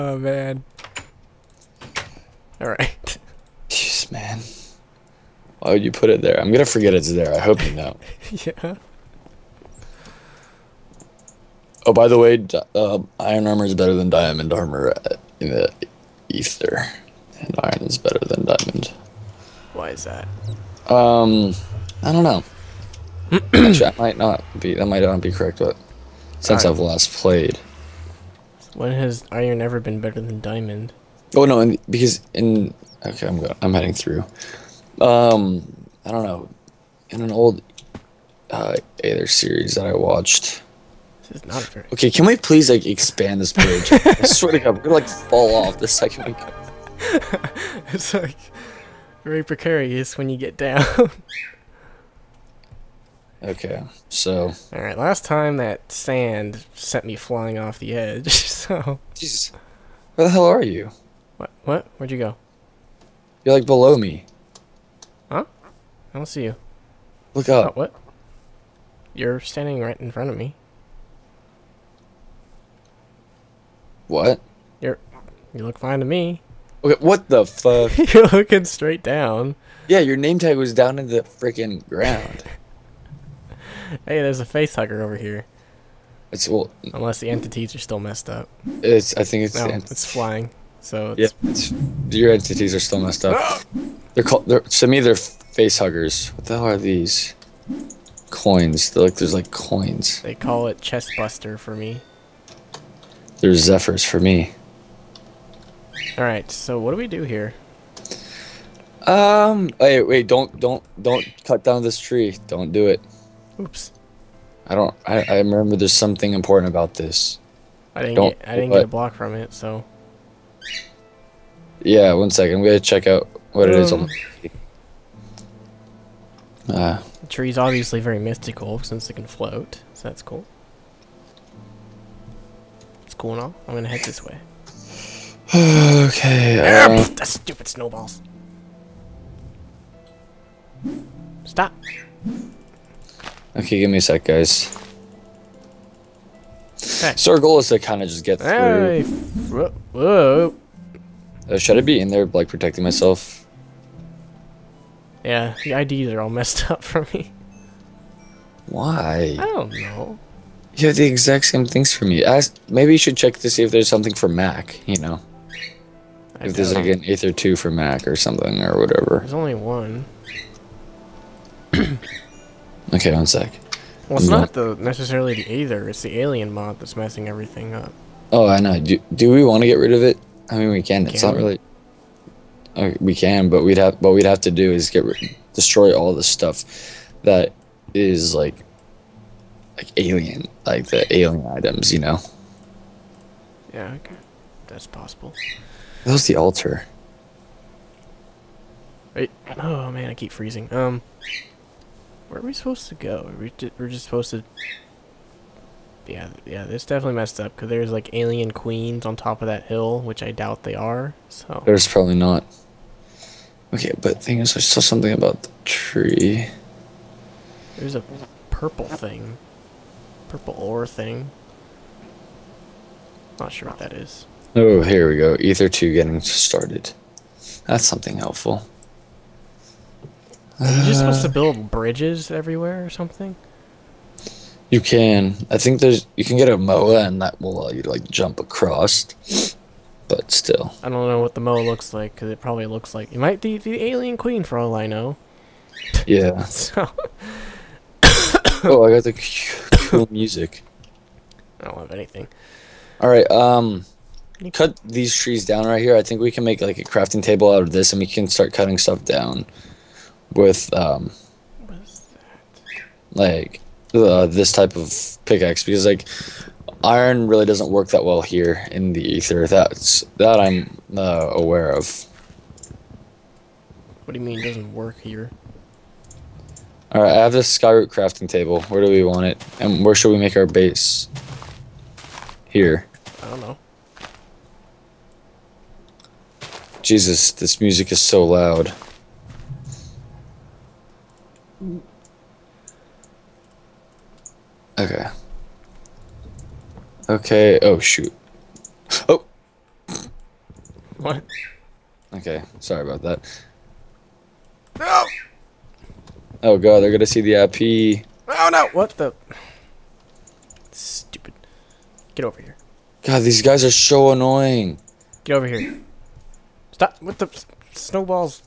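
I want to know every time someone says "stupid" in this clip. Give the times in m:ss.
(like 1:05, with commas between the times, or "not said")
2:17, 5:10.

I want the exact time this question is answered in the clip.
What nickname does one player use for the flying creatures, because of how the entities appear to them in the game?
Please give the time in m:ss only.
1:24.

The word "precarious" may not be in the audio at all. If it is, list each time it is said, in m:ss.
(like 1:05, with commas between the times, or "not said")
0:49.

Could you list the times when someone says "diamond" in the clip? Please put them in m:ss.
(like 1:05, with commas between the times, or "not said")
0:14, 0:18, 0:30.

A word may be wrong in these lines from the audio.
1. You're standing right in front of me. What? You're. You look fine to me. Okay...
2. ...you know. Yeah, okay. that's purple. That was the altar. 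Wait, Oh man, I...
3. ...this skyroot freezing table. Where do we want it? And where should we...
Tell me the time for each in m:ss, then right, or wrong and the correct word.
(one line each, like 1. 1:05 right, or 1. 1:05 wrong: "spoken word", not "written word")
1. 1:09 right
2. 3:11 wrong: "possible", not "purple"
3. 4:37 wrong: "crafting", not "freezing".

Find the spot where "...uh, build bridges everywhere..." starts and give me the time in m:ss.
3:51.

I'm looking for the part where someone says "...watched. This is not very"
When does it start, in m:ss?
0:39.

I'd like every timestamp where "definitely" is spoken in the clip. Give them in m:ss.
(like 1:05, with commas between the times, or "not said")
3:26.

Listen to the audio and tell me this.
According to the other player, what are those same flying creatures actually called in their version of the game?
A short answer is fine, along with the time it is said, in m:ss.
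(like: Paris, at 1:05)
zephyrs, at 1:43.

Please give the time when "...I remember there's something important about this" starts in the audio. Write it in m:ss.
1:55.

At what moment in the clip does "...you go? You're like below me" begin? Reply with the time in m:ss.
1:02.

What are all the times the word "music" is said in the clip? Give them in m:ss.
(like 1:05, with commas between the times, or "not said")
4:10, 4:47.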